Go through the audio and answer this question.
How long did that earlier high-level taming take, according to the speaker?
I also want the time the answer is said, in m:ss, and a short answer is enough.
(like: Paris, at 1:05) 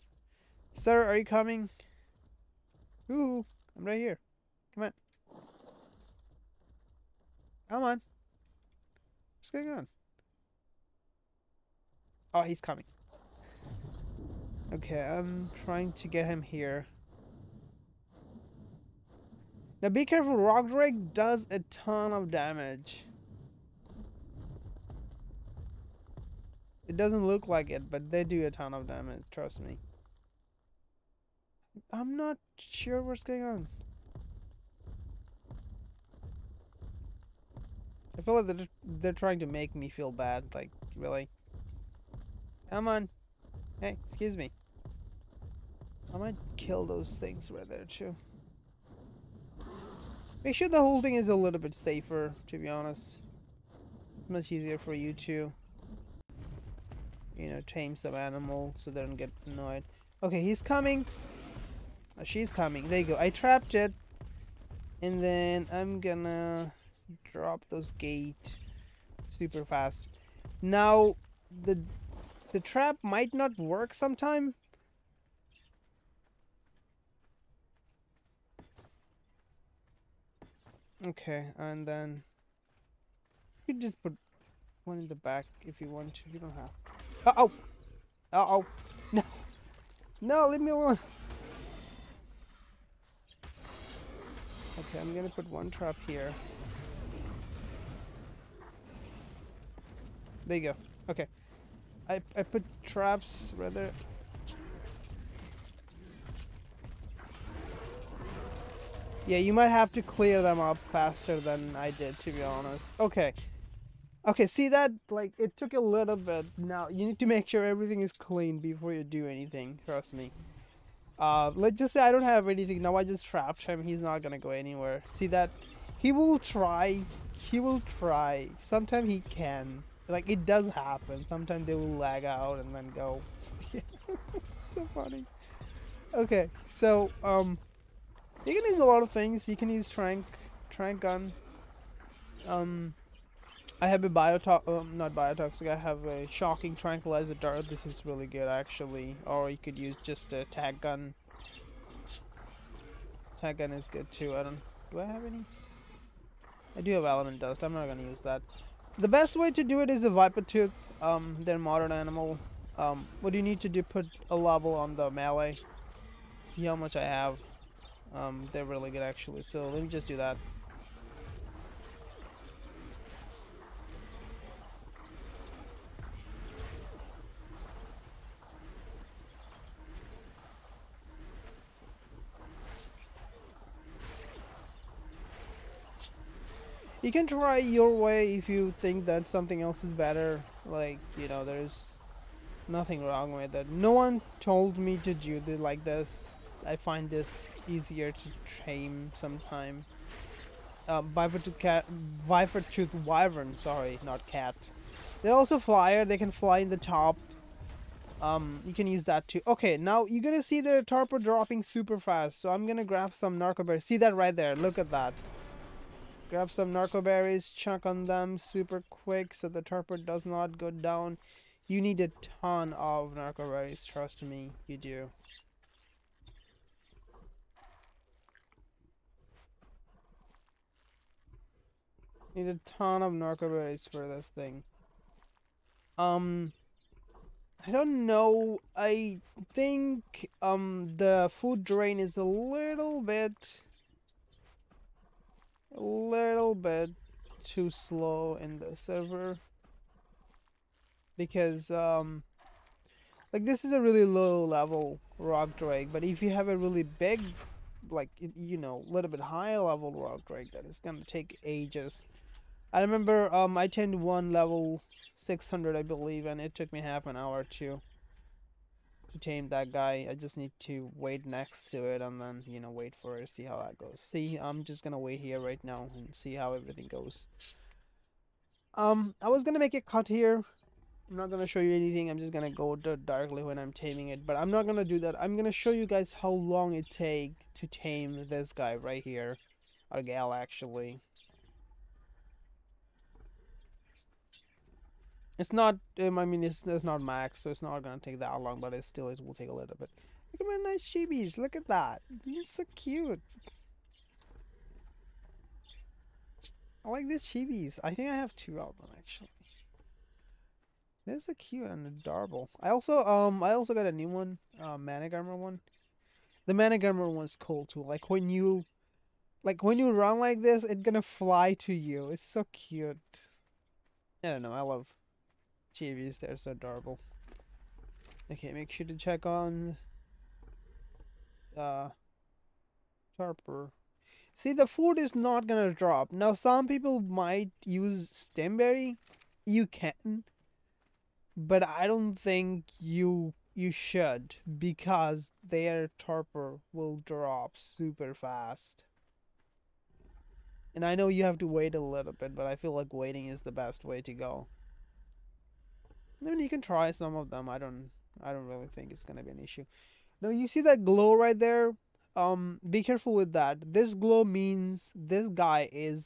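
half an hour, at 4:26.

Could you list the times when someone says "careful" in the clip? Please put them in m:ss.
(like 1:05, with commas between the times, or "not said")
0:20, 6:02.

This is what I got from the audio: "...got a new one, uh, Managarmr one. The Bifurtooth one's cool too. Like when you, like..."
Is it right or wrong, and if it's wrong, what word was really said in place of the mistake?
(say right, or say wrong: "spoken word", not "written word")
wrong: "Managarmr", not "Bifurtooth".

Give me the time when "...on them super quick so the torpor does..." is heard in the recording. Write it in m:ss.
3:37.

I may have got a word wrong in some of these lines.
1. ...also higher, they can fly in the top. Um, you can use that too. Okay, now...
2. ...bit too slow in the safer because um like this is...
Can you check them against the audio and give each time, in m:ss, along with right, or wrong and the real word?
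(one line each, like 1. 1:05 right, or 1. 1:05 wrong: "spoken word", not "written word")
1. 3:25 wrong: "flyer", not "higher"
2. 4:06 wrong: "server", not "safer".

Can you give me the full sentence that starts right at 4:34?
See, I'm just gonna wait here right now and see how everything goes.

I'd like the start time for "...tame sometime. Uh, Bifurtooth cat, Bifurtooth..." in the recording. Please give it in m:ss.
3:18.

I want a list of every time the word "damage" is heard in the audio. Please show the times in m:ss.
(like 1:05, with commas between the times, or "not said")
0:22, 0:28.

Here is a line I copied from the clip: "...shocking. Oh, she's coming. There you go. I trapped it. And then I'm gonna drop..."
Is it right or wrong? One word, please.
wrong.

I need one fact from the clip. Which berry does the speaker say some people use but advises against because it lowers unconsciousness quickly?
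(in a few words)
stemberry.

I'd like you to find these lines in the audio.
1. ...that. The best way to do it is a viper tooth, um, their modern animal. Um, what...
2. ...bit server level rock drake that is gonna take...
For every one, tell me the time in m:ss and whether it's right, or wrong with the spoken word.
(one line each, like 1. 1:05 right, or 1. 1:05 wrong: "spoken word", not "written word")
1. 2:38 right
2. 4:19 wrong: "higher", not "server".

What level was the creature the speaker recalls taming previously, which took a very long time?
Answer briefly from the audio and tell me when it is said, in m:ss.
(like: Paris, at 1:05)
600, at 4:24.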